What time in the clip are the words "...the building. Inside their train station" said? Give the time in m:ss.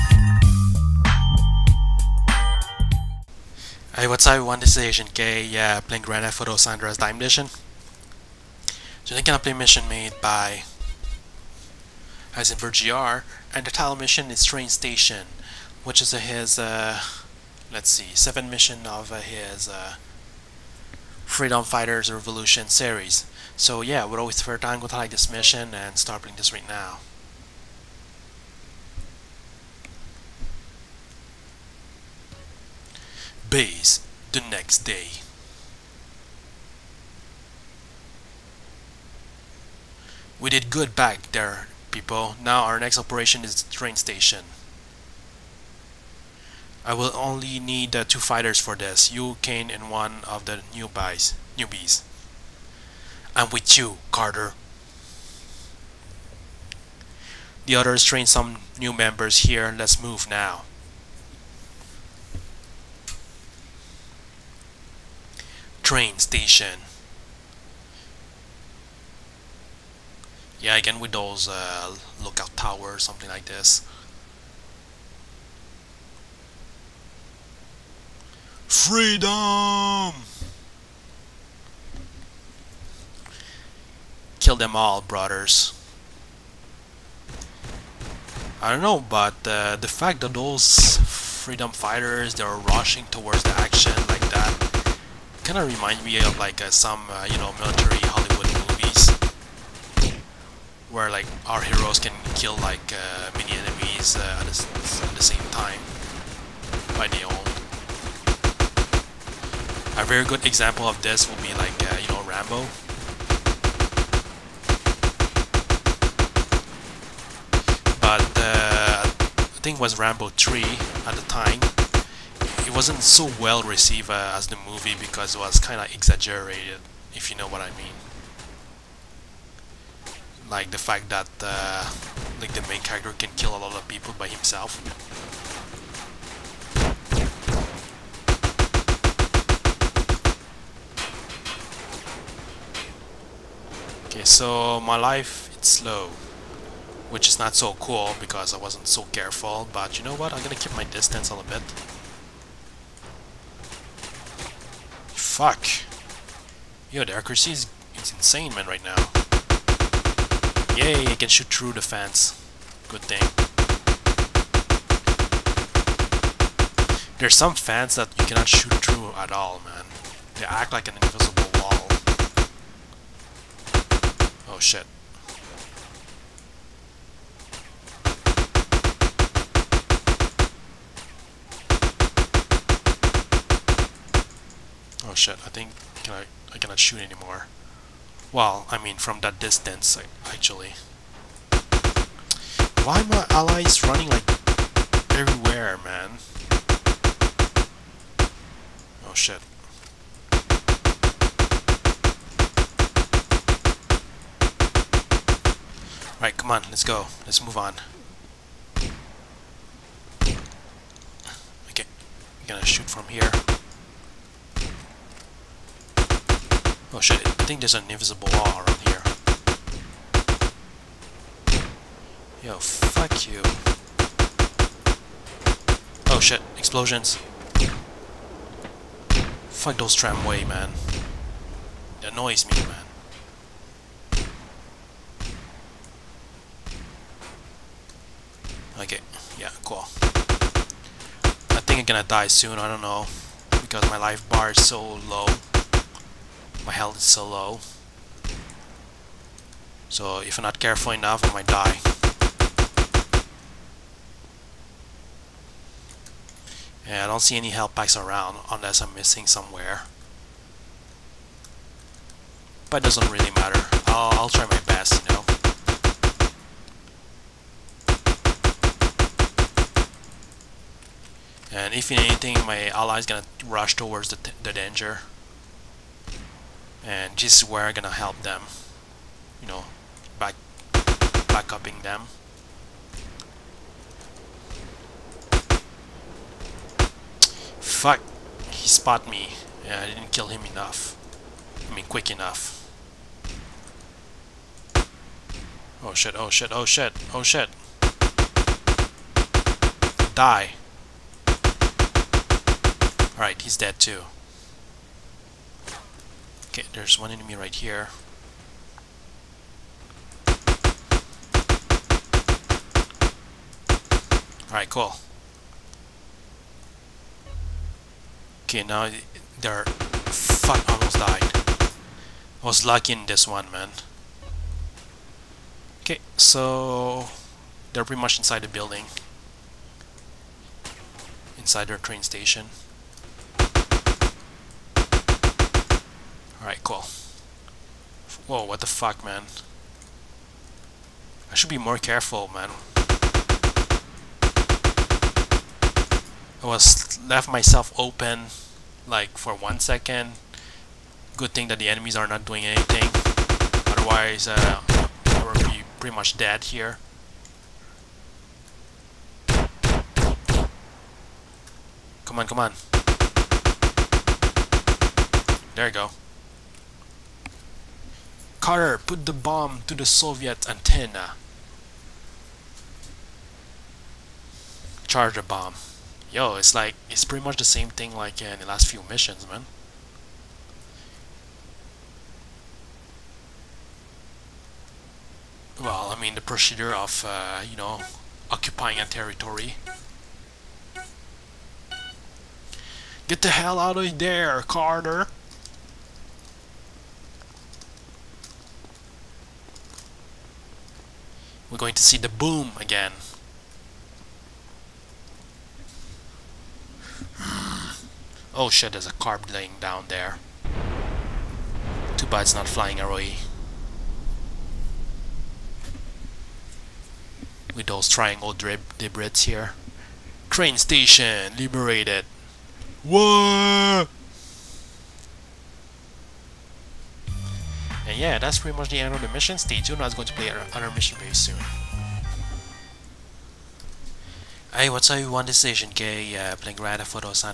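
5:28.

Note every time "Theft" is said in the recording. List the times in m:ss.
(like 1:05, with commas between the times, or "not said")
0:06, 7:16.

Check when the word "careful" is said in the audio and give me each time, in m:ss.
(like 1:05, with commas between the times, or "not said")
2:29, 4:10, 5:41.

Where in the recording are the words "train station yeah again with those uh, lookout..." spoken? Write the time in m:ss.
1:05.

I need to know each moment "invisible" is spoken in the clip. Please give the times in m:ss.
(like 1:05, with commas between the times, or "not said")
2:51, 3:37.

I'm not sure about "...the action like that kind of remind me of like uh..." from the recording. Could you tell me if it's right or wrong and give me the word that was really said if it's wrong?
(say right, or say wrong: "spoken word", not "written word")
right.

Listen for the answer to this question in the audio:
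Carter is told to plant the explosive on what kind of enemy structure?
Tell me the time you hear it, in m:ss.
6:09.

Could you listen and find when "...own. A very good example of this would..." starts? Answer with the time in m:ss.
1:47.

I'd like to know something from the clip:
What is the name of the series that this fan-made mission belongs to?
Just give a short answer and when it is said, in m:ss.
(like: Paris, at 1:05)
Freedom Fighters Revolution, at 0:21.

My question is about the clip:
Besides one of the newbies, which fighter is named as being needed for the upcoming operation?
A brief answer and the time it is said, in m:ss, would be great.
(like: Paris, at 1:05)
Kane, at 0:49.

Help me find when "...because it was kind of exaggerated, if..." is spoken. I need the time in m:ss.
2:04.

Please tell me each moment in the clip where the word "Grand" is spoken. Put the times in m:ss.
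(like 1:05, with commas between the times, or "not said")
0:06, 7:16.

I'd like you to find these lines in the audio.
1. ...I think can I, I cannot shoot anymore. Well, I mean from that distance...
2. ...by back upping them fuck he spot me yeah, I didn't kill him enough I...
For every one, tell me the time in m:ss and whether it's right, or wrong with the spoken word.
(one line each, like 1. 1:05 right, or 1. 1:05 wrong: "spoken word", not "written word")
1. 3:05 right
2. 4:40 right.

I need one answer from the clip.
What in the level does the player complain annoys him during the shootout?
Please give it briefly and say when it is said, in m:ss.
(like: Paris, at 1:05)
Tramway, at 3:49.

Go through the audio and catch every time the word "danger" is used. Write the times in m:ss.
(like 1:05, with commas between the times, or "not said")
4:34.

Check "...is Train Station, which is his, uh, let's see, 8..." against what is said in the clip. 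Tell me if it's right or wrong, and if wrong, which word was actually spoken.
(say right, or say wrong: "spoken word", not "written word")
wrong: "7", not "8".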